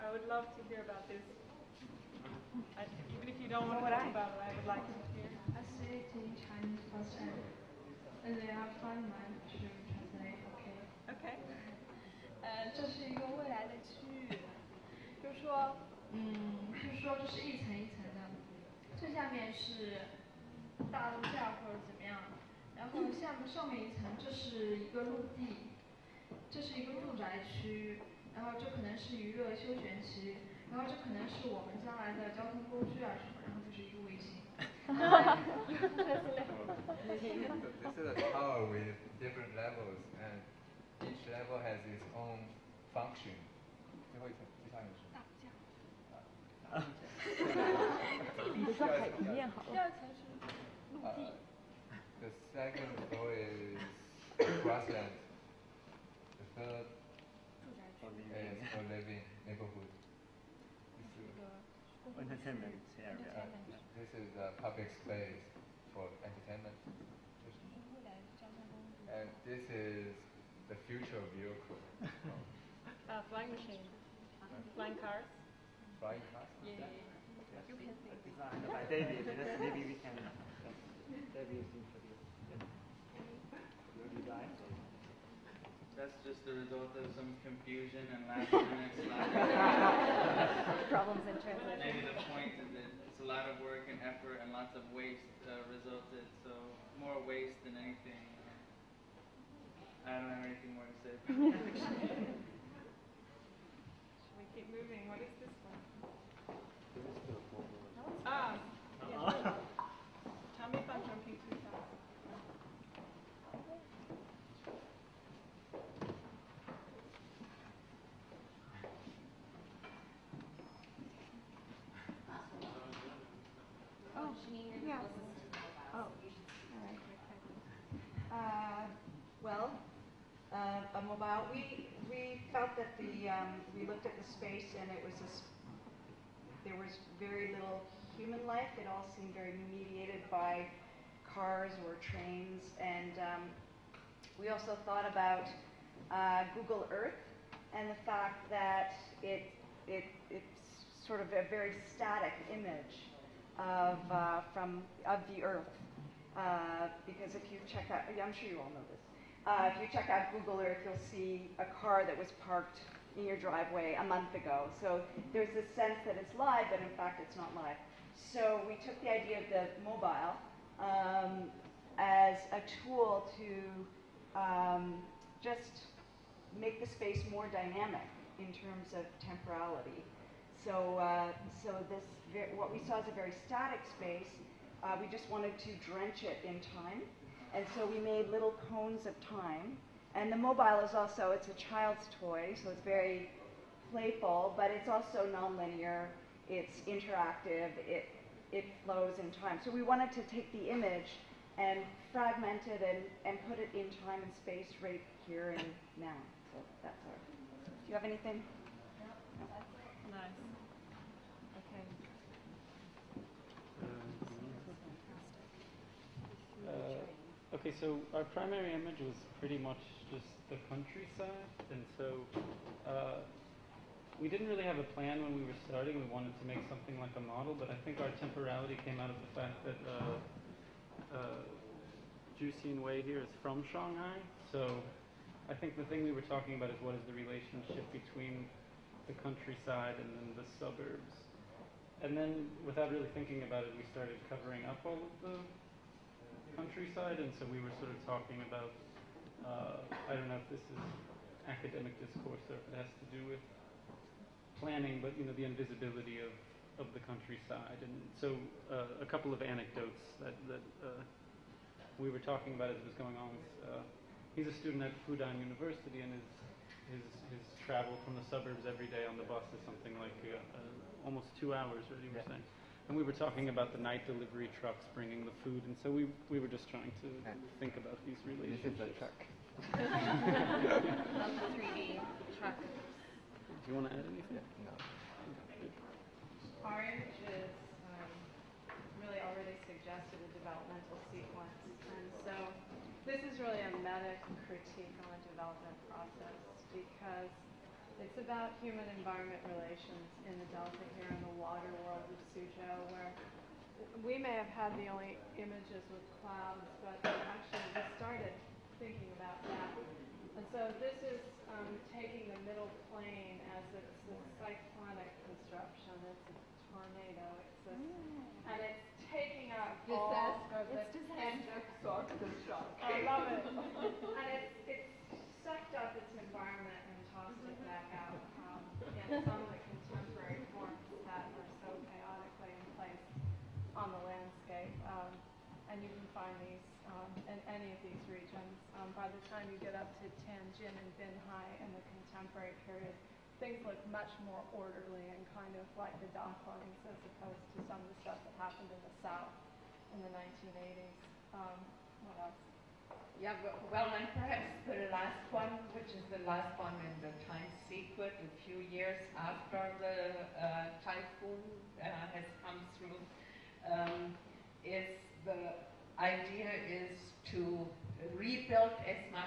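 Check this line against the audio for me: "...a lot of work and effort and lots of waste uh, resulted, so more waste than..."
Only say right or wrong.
right.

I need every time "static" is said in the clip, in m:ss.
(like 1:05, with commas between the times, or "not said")
2:31, 3:03.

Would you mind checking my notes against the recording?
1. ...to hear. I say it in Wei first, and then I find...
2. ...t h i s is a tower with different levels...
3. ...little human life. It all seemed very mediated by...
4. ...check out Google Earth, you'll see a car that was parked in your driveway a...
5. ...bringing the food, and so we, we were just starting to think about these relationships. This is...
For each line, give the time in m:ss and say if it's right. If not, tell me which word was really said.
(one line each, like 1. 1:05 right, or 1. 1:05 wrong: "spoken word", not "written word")
1. 0:04 wrong: "Chinese", not "Wei"
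2. 0:34 right
3. 2:17 right
4. 2:39 right
5. 4:34 wrong: "trying", not "starting".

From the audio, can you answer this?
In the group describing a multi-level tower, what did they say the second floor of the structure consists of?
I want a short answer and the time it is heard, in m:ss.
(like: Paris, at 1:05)
Grassland, at 0:54.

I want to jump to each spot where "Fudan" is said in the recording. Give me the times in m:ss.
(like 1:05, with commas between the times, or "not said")
4:25.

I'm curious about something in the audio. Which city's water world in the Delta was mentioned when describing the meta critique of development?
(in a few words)
Suzhou.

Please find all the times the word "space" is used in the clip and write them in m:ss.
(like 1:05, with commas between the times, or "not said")
1:05, 2:14, 2:56, 3:03, 3:24.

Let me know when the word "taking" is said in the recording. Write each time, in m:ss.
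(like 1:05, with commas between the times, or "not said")
5:11, 5:19.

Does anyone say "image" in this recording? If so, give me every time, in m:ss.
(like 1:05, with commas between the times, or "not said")
2:32, 3:20, 3:38, 5:05.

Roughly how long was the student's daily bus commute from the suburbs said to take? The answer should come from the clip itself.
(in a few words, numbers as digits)
Almost two hours.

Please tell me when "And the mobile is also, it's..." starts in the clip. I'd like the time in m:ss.
3:10.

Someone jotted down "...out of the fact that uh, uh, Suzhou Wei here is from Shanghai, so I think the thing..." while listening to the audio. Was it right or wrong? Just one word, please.
wrong.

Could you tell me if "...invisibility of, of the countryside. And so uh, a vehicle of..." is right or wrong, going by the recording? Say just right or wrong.
wrong.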